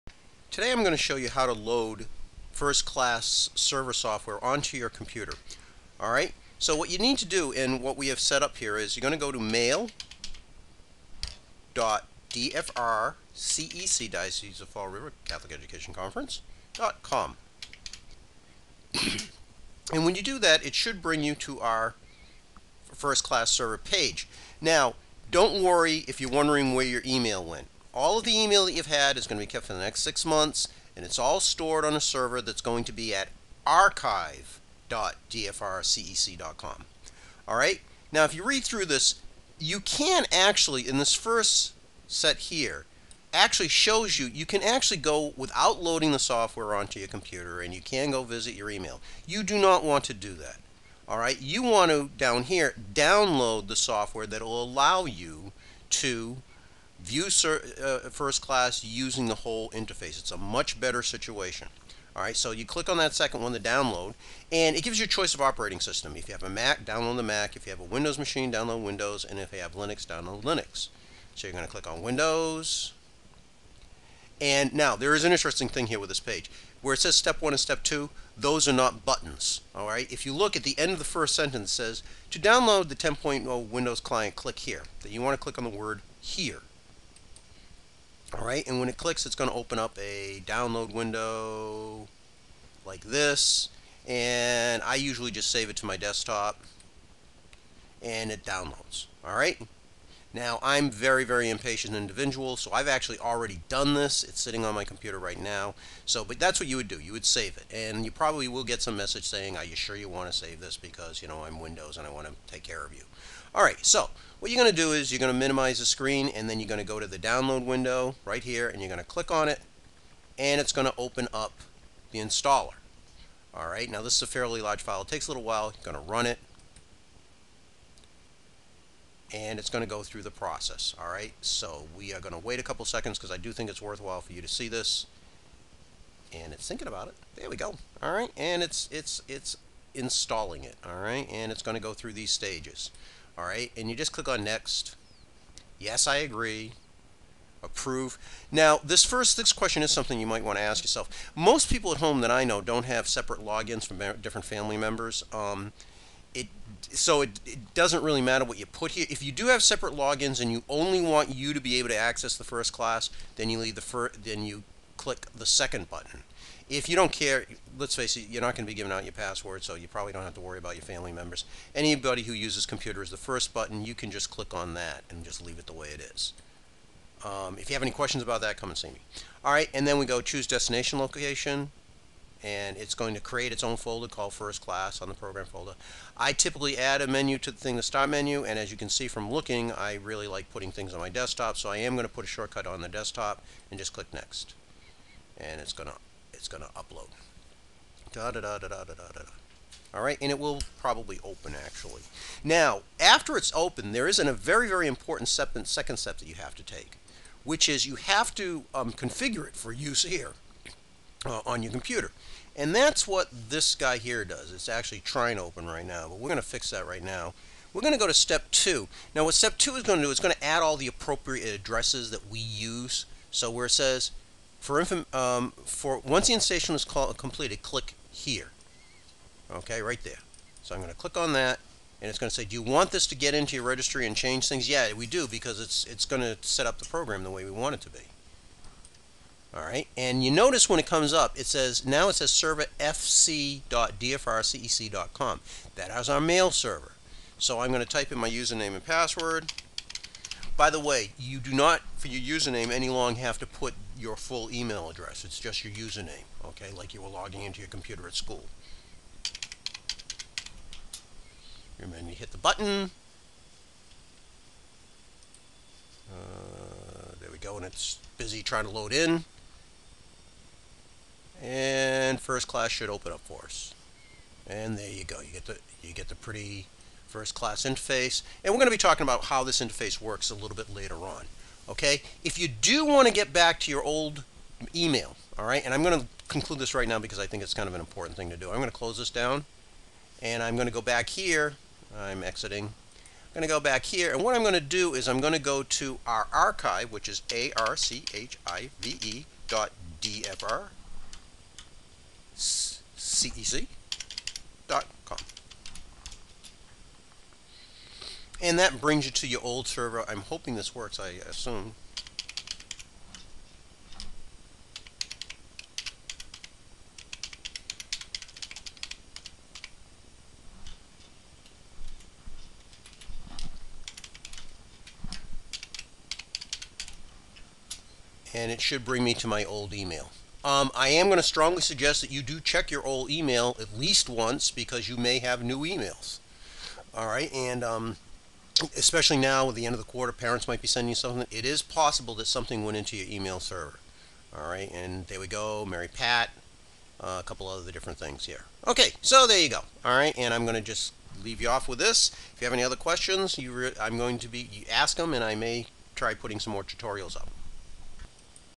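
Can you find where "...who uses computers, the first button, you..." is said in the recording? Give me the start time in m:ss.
2:52.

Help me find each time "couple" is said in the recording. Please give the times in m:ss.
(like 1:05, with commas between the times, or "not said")
2:12, 5:47.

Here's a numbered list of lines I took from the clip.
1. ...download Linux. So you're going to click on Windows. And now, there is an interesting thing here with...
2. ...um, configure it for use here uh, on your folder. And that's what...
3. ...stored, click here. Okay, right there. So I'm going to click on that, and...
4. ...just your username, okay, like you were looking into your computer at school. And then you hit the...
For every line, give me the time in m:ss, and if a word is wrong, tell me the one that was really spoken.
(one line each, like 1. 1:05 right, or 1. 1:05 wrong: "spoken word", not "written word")
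1. 1:10 right
2. 3:28 wrong: "computer", not "folder"
3. 3:46 wrong: "completed", not "stored"
4. 4:15 wrong: "logging", not "looking".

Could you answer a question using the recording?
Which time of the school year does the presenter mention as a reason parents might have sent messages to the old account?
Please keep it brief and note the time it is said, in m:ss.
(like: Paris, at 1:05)
end of the quarter, at 5:39.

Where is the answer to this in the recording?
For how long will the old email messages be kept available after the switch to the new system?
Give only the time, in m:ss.
0:30.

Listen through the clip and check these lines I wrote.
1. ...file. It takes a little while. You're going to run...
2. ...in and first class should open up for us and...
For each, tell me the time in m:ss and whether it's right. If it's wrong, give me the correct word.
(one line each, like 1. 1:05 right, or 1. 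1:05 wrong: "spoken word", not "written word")
1. 2:04 right
2. 4:28 right.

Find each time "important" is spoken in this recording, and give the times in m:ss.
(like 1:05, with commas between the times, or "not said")
3:24, 4:47.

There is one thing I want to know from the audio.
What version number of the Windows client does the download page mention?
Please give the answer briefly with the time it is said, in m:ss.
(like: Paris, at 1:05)
10.0, at 1:22.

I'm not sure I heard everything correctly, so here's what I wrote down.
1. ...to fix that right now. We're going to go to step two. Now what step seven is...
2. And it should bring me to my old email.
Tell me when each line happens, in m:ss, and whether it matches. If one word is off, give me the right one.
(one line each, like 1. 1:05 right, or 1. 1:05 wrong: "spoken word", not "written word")
1. 3:36 wrong: "two", not "seven"
2. 5:28 right.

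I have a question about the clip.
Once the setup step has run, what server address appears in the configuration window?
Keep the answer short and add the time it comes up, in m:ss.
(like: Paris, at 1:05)
fc.dfrcec.com, at 4:02.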